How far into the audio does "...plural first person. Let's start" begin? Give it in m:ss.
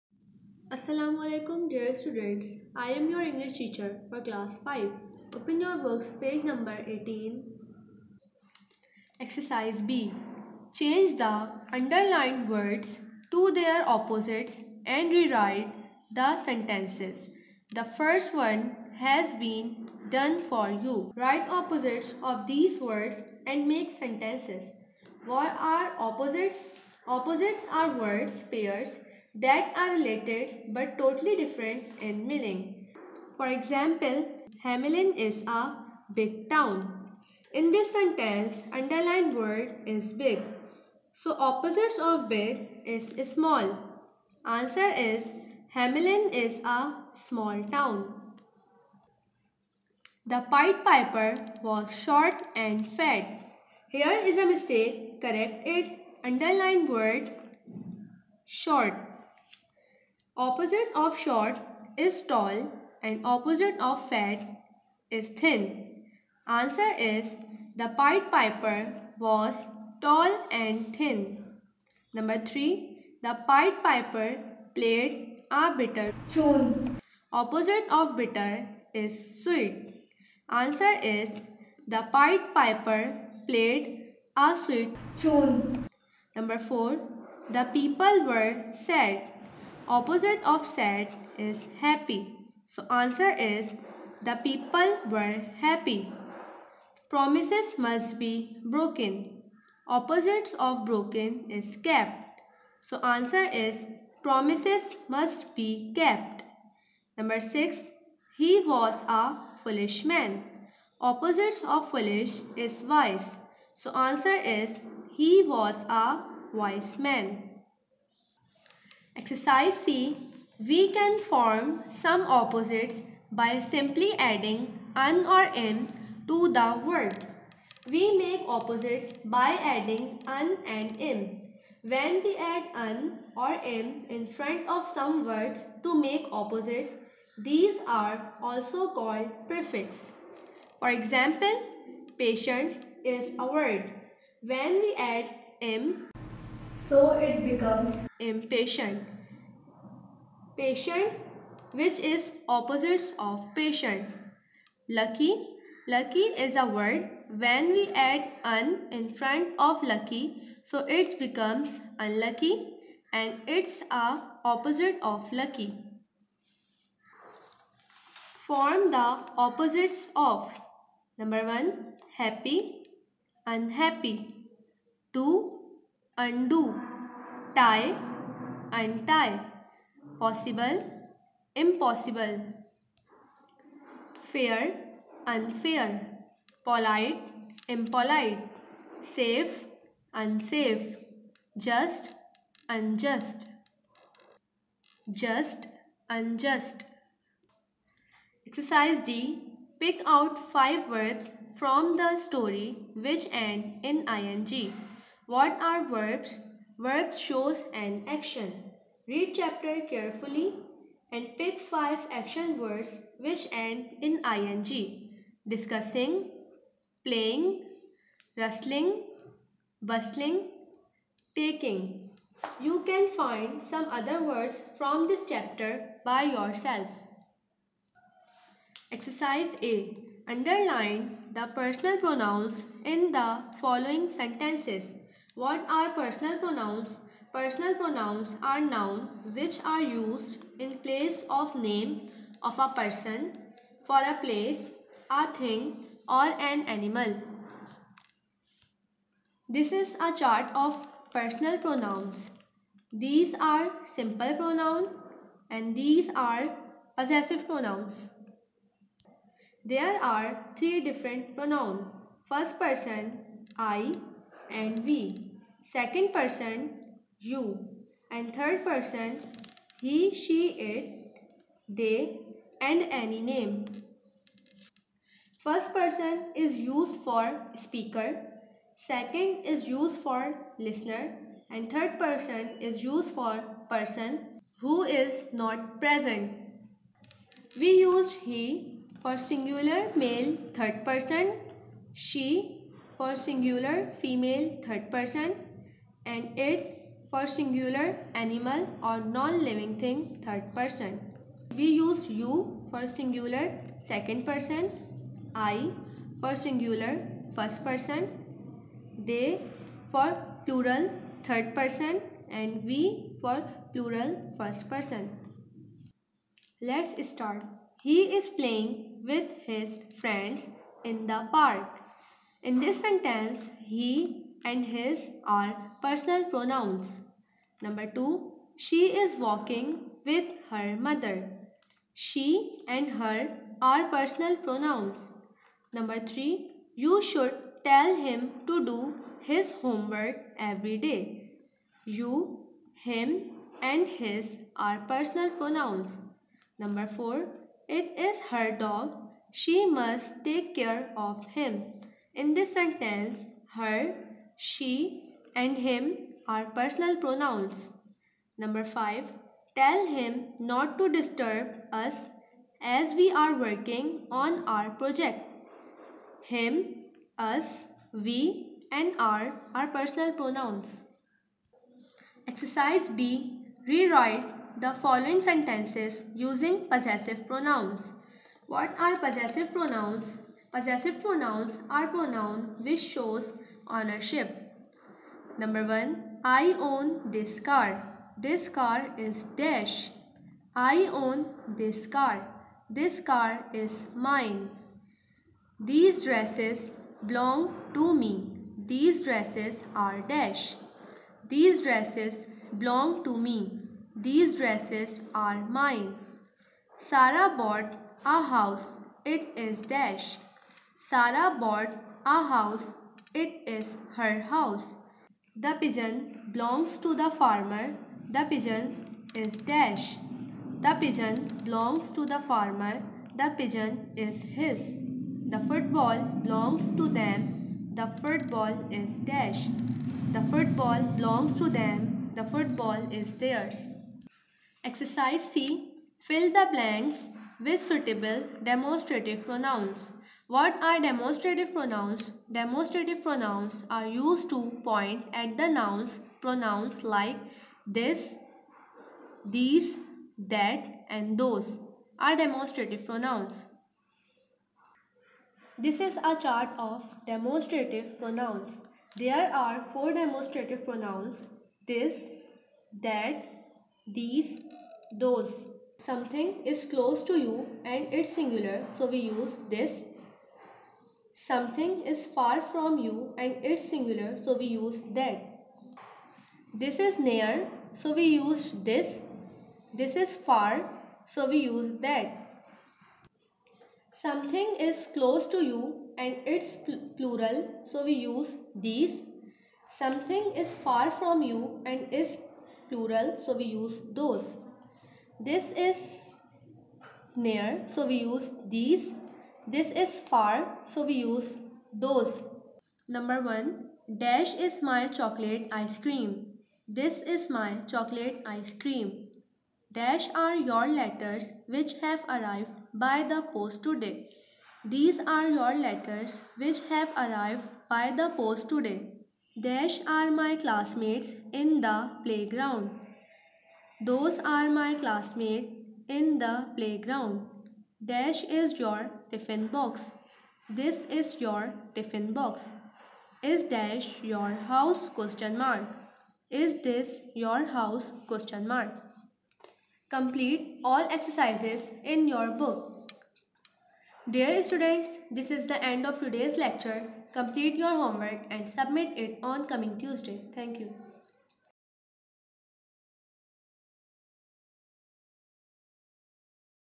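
5:13.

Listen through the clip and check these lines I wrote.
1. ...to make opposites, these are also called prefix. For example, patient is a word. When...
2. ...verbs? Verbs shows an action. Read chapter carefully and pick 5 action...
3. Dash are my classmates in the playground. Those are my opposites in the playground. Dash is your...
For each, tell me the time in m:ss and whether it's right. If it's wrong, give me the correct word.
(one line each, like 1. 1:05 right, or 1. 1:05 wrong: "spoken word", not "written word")
1. 2:15 right
2. 3:25 right
3. 8:39 wrong: "classmates", not "opposites".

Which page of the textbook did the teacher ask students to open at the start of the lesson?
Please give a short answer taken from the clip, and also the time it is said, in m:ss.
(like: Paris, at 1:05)
18, at 0:06.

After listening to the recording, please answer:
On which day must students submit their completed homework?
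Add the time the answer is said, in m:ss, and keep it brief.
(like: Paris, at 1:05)
Tuesday, at 9:09.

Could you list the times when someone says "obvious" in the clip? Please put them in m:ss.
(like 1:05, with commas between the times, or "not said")
not said.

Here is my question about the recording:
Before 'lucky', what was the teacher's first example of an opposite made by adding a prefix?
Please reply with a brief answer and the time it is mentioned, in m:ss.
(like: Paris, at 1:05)
impatient, at 2:28.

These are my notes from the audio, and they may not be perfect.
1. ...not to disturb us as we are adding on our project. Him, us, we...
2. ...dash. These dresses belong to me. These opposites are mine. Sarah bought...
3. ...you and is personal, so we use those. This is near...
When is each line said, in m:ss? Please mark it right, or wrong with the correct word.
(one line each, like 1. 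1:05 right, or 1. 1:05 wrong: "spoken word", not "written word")
1. 6:00 wrong: "working", not "adding"
2. 6:40 wrong: "dresses", not "opposites"
3. 8:11 wrong: "plural", not "personal".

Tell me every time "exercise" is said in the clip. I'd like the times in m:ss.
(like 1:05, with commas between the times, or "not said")
0:09, 1:59, 3:18, 3:48, 6:12, 7:14, 9:00.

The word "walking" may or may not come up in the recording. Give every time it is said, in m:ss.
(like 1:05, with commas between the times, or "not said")
5:29.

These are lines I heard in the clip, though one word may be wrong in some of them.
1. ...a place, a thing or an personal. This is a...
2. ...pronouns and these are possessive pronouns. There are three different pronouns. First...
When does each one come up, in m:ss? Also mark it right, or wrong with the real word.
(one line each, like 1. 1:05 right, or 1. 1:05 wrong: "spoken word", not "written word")
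1. 4:03 wrong: "animal", not "personal"
2. 4:14 right.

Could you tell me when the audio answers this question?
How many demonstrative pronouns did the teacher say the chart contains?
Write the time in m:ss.
7:39.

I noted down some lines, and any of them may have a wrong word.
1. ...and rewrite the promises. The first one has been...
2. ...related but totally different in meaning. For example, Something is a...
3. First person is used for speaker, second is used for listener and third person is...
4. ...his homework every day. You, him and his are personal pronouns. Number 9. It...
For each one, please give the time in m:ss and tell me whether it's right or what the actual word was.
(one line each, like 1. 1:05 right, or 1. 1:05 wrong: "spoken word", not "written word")
1. 0:14 wrong: "sentences", not "promises"
2. 0:29 wrong: "Hamelin", not "Something"
3. 4:35 right
4. 5:39 wrong: "4", not "9".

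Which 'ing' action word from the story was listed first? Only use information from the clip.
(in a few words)
Discussing.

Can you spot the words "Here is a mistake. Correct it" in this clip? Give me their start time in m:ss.
0:53.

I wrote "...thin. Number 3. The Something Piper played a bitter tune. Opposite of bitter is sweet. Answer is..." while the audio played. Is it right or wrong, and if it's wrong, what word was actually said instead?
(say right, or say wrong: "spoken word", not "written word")
wrong: "Pied", not "Something".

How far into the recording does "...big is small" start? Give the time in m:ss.
0:42.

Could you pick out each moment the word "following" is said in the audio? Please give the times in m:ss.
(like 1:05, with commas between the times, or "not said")
3:53, 6:14.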